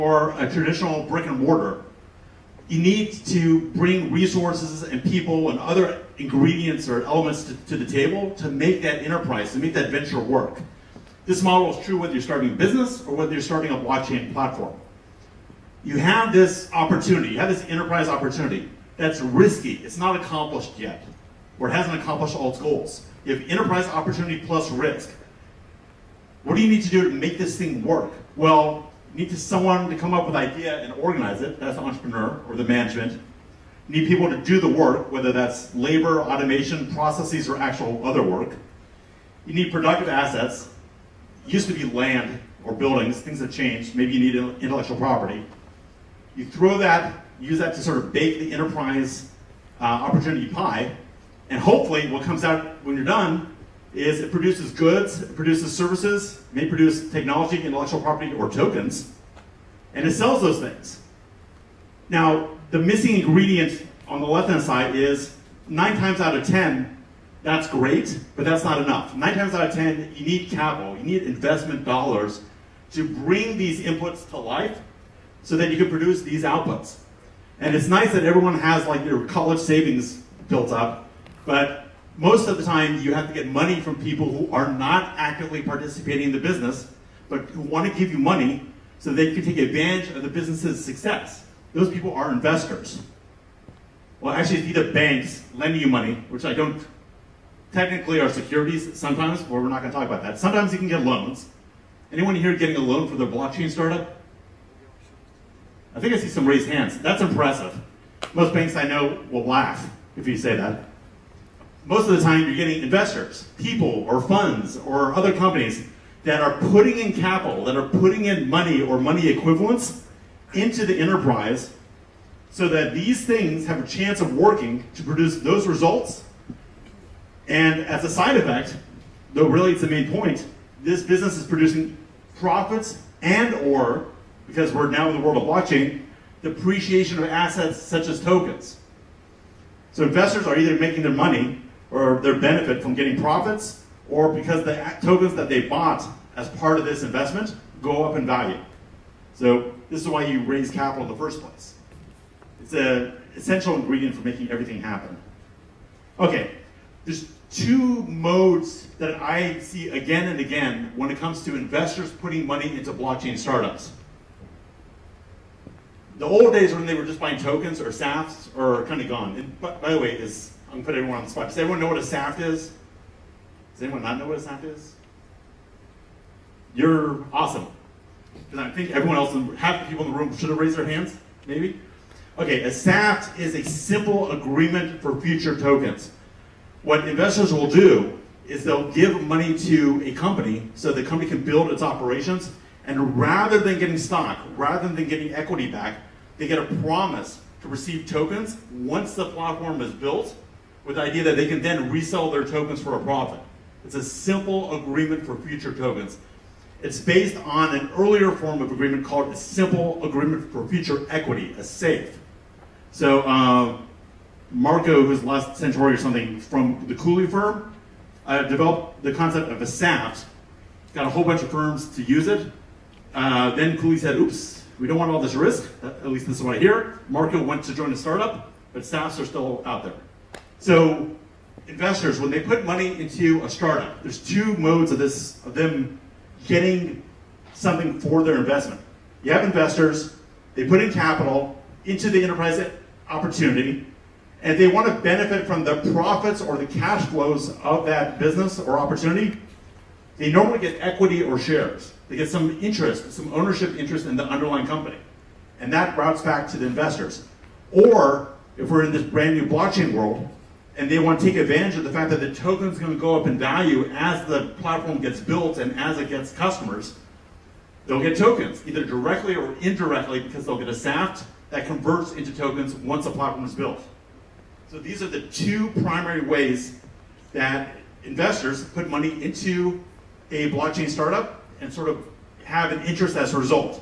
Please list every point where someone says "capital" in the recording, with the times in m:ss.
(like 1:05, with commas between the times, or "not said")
1:10, 1:57, 2:30, 4:00.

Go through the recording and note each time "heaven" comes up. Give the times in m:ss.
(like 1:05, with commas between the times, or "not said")
not said.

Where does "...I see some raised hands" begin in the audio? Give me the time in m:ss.
1:46.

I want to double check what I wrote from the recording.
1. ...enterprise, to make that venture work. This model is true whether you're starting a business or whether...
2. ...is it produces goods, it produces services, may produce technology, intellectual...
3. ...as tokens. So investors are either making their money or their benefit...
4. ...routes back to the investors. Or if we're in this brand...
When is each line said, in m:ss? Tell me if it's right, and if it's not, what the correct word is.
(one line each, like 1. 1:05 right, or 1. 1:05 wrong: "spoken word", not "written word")
1. 0:09 right
2. 0:53 right
3. 2:18 right
4. 4:15 right.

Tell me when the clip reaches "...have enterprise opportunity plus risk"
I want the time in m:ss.
0:23.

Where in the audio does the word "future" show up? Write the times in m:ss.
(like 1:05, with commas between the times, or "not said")
3:05, 3:25, 3:30.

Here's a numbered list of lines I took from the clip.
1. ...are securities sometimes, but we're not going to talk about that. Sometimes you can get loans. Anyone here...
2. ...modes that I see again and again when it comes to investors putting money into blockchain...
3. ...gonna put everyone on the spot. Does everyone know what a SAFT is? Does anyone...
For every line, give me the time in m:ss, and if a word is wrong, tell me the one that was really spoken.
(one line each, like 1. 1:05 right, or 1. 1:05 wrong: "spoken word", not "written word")
1. 1:38 right
2. 2:38 right
3. 2:50 right.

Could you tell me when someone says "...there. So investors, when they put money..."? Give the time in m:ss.
3:49.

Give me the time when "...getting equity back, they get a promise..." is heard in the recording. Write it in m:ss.
3:15.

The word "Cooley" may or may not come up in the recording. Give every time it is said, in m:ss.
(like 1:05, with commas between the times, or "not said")
3:36, 3:43.